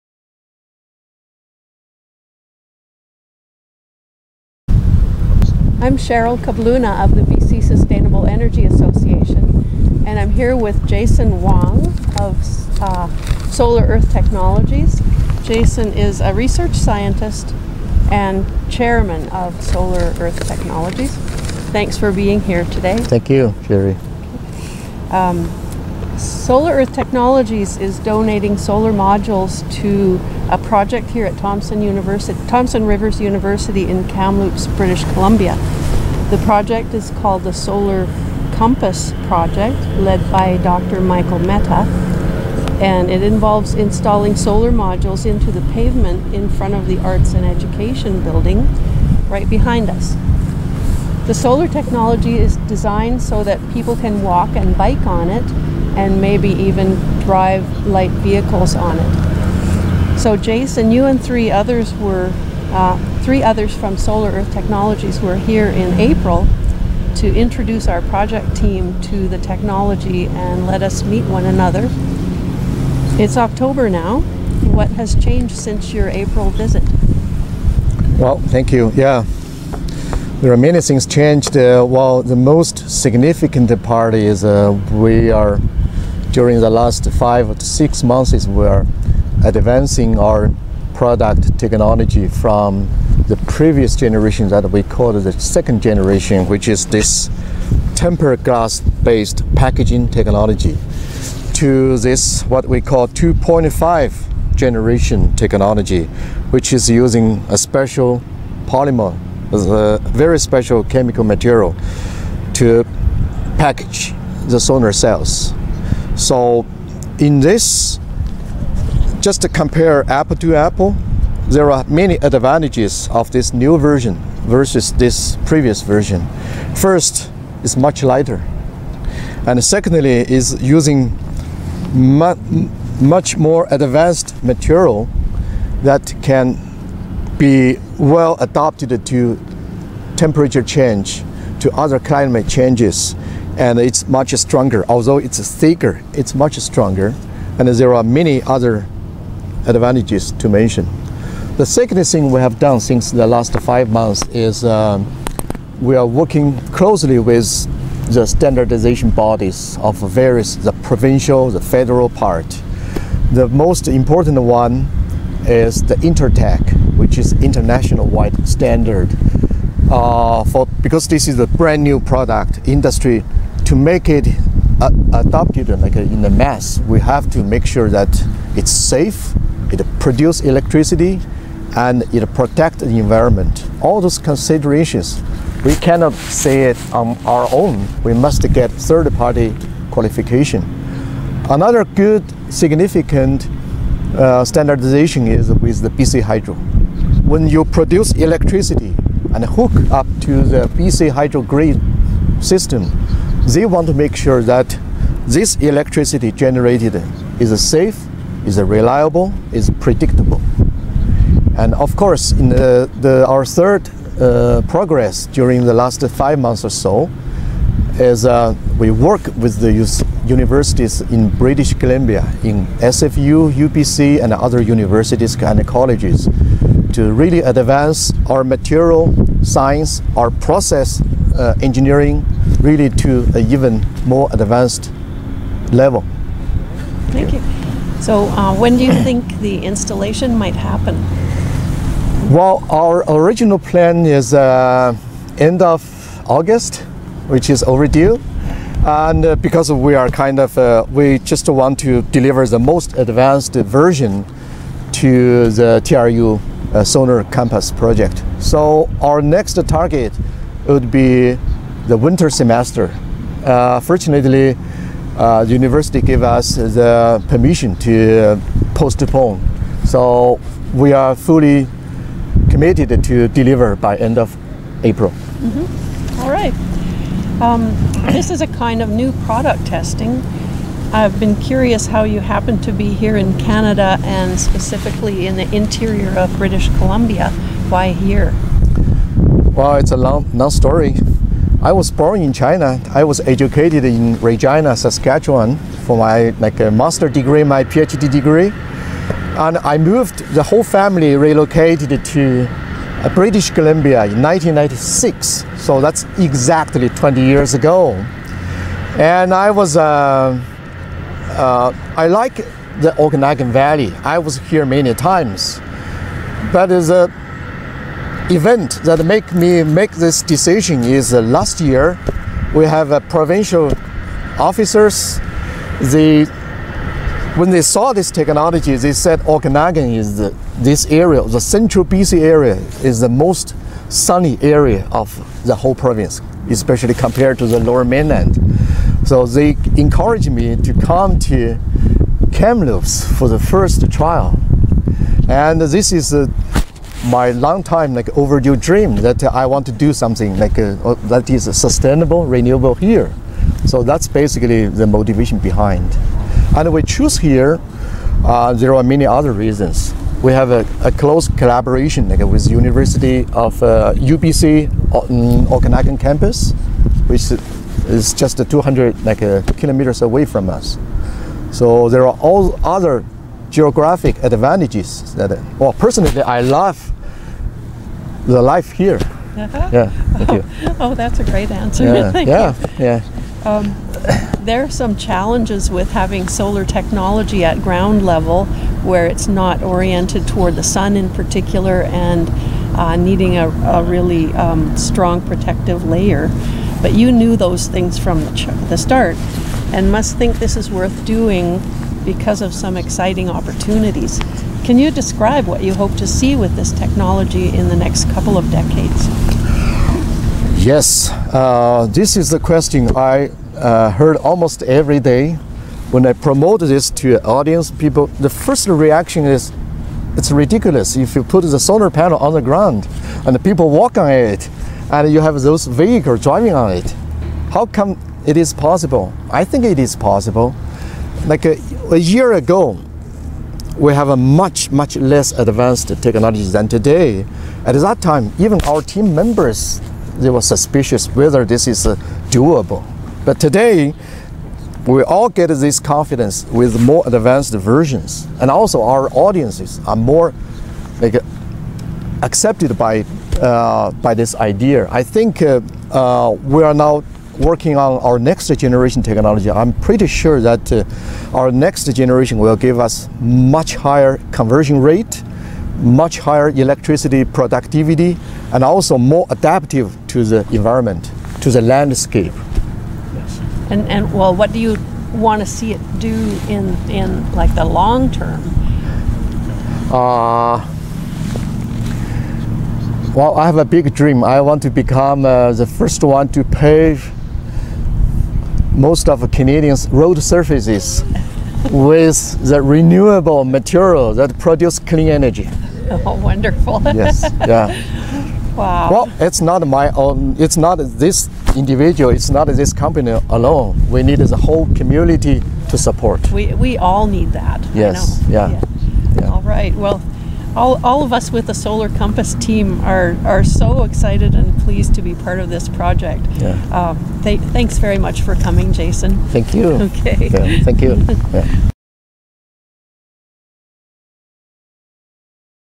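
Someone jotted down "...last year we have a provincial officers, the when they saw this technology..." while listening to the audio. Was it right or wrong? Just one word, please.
right.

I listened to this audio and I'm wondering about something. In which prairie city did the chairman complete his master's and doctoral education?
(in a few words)
Regina.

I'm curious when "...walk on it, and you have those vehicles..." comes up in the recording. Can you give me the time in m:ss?
7:03.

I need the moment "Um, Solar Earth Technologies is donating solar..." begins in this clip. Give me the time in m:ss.
0:25.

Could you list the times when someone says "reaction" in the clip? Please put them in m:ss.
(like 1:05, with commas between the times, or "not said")
6:58.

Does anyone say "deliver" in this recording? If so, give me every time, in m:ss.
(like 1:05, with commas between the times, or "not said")
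4:12, 4:33.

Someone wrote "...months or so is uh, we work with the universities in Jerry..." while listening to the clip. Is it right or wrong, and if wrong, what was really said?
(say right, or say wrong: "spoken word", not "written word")
wrong: "British", not "Jerry".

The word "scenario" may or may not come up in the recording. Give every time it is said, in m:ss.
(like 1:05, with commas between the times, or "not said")
not said.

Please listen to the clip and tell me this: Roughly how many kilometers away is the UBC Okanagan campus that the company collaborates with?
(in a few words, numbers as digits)
200.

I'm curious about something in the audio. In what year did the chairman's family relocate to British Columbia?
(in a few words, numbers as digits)
1996.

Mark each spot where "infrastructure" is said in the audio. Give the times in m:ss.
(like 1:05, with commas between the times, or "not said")
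not said.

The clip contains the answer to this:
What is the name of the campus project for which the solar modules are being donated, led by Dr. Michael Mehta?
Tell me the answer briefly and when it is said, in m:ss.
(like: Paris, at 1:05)
Solar Compass Project, at 0:37.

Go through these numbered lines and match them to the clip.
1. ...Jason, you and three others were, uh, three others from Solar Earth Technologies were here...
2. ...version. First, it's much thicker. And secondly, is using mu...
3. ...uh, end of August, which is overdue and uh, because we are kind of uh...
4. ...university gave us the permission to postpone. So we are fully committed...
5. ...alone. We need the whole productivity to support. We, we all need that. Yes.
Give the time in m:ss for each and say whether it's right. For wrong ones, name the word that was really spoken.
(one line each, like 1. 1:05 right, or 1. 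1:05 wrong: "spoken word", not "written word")
1. 1:00 right
2. 2:05 wrong: "lighter", not "thicker"
3. 4:04 right
4. 4:25 right
5. 8:23 wrong: "community", not "productivity".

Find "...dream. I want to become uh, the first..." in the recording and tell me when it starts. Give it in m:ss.
8:03.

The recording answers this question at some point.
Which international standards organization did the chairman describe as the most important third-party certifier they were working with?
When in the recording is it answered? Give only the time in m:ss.
2:45.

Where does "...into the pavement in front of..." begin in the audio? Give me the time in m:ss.
0:45.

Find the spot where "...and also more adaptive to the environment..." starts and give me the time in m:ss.
7:48.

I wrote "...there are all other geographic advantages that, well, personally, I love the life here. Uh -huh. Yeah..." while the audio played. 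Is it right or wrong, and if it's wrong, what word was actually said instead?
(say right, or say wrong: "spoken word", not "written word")
right.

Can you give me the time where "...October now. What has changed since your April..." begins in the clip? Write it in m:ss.
1:13.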